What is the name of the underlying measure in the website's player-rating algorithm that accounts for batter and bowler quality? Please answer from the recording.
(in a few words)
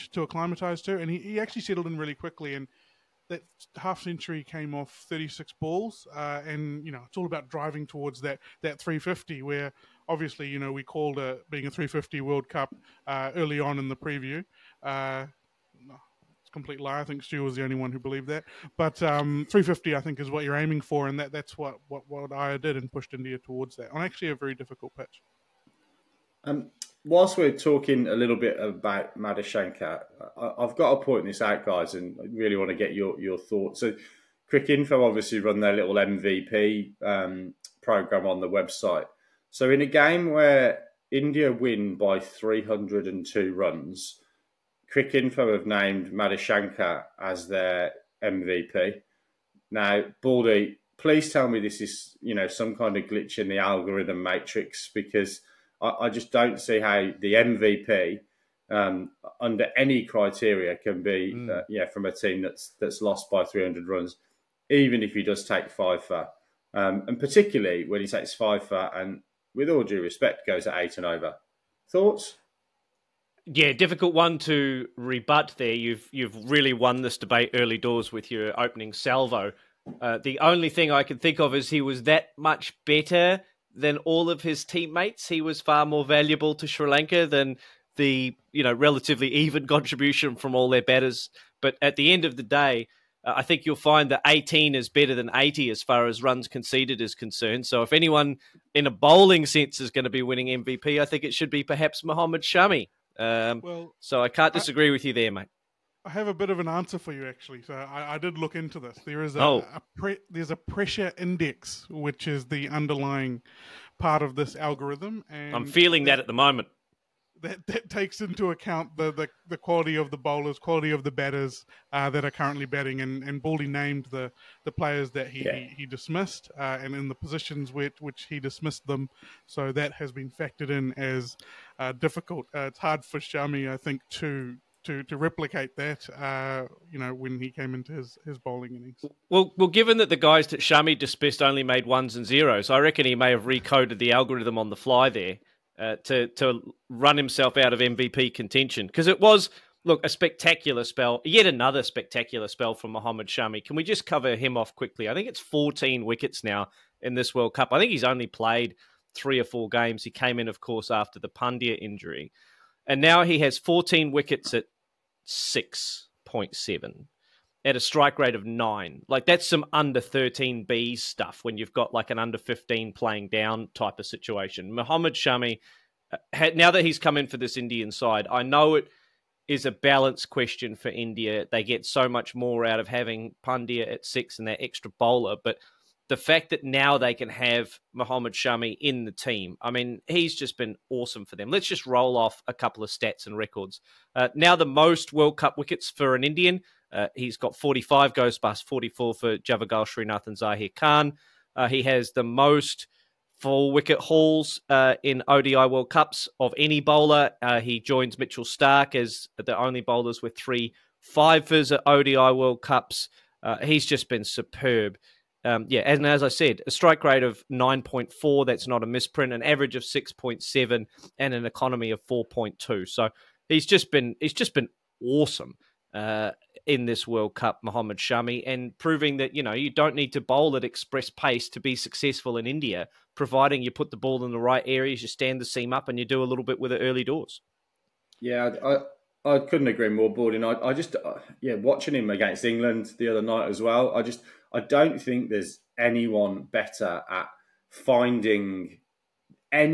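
Pressure index.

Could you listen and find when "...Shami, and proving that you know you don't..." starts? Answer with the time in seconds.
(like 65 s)
227 s.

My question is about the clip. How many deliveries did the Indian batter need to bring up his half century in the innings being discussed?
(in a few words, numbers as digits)
36.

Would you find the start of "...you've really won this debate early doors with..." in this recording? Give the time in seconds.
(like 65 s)
76 s.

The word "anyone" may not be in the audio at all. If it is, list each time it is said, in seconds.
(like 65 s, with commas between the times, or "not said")
97 s, 245 s.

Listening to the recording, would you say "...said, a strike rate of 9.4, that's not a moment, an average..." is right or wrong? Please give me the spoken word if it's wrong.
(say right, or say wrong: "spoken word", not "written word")
wrong: "misprint", not "moment".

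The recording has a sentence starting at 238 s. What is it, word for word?
Yeah, I, I couldn't agree more, Borden.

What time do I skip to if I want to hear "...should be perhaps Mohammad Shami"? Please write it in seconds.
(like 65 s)
101 s.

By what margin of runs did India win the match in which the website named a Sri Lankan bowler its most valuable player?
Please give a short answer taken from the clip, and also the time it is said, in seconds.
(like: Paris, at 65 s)
302 runs, at 42 s.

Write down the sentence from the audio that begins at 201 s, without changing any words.
Uh, he has the most full wicket hauls uh, in ODI World Cups of any bowler.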